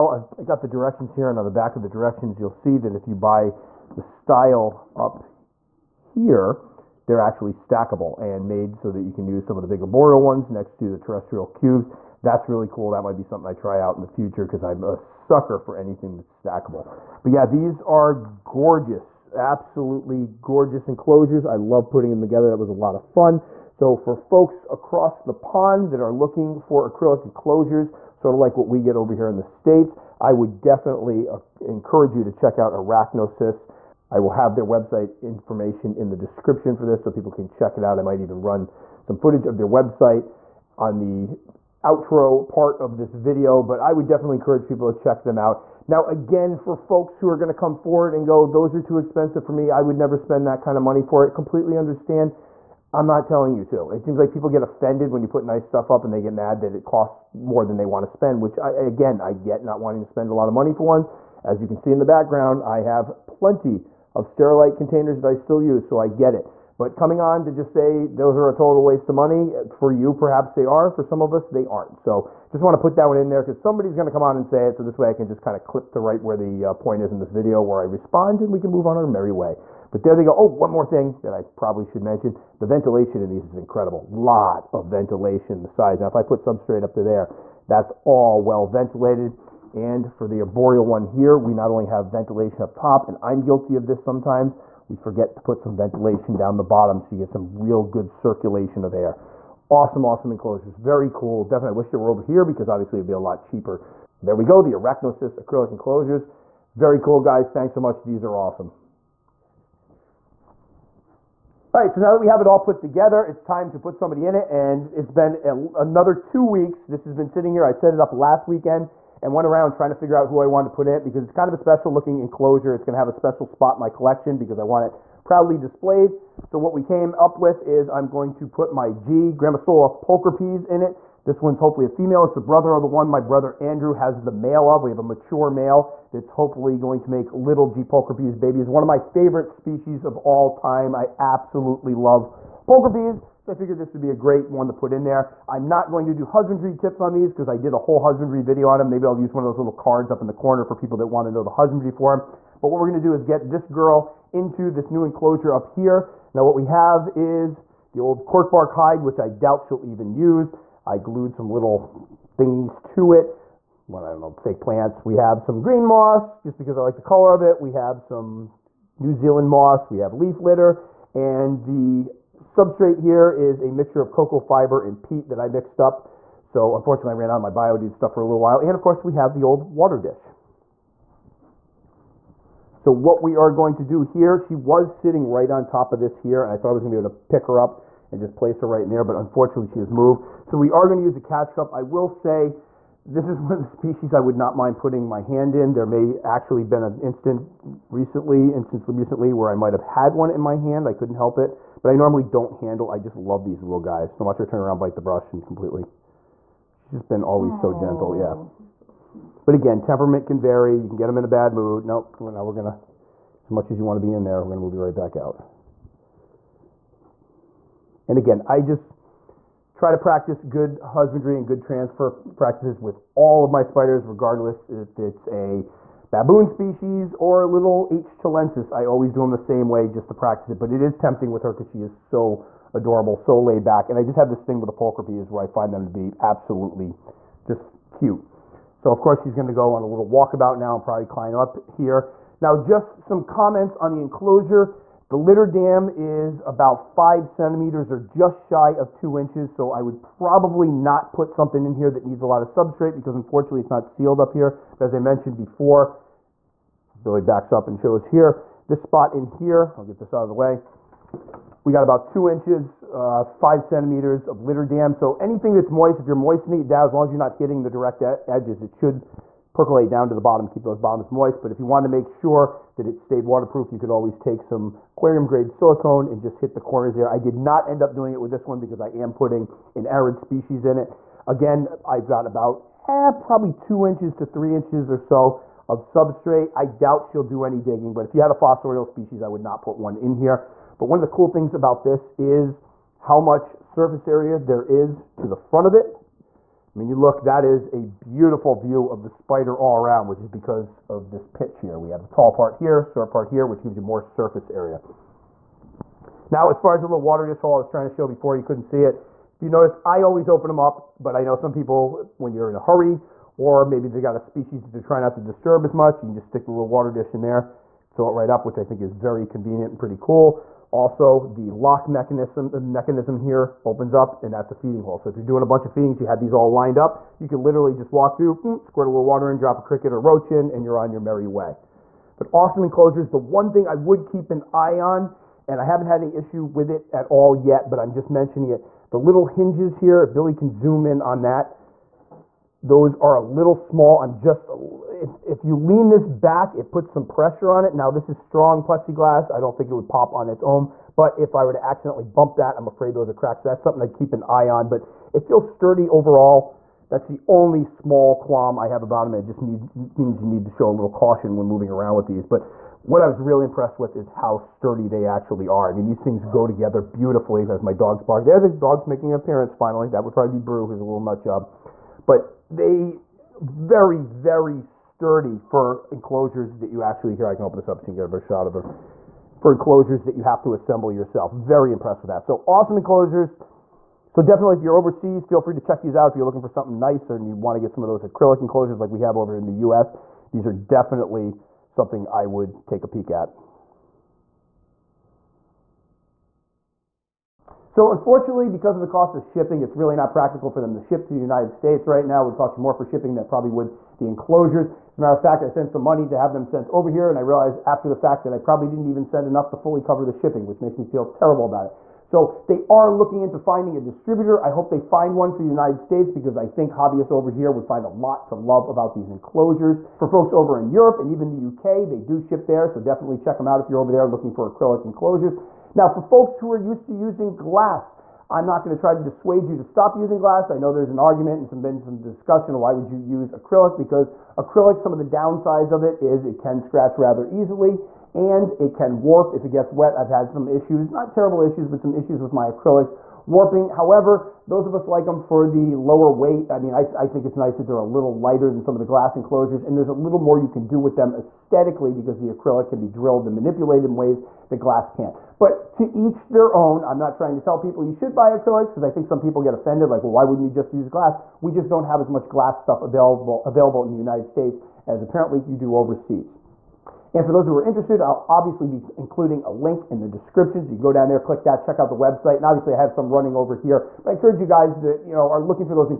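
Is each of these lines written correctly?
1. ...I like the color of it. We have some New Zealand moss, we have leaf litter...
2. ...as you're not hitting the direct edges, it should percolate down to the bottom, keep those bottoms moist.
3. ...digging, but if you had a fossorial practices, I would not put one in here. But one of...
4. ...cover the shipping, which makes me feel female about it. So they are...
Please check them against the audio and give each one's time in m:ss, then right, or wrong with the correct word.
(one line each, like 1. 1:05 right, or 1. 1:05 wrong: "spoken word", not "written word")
1. 2:46 right
2. 4:27 right
3. 4:47 wrong: "species", not "practices"
4. 6:49 wrong: "terrible", not "female".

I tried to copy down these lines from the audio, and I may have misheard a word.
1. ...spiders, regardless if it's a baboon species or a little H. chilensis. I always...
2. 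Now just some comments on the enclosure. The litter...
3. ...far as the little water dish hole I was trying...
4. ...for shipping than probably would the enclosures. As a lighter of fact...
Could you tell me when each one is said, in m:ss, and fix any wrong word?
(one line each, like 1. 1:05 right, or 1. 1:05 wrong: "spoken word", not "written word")
1. 3:43 right
2. 4:02 right
3. 5:06 right
4. 6:42 wrong: "matter", not "lighter".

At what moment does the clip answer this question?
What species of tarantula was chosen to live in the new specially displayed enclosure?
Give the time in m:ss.
2:09.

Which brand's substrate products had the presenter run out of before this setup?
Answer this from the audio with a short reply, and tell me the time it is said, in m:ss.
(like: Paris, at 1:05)
BioDude, at 2:57.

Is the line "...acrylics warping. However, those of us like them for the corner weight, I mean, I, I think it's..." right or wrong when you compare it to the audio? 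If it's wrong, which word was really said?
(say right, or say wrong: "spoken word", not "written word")
wrong: "lower", not "corner".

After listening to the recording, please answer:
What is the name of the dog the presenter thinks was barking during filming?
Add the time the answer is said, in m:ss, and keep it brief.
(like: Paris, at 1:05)
Brew, at 6:10.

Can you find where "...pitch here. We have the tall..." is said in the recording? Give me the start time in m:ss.
5:01.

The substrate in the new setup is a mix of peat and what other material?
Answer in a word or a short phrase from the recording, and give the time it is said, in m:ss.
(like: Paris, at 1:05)
cocoa fiber, at 2:54.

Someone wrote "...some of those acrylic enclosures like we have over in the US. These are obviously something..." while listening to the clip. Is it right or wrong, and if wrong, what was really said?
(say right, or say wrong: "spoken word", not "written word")
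wrong: "definitely", not "obviously".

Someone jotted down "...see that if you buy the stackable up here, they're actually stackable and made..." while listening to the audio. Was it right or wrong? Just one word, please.
wrong.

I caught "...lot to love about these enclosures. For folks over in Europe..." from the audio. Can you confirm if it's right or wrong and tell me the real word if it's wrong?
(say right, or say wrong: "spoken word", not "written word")
right.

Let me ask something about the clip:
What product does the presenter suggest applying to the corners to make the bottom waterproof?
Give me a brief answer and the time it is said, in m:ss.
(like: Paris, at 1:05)
aquarium grade silicone, at 4:34.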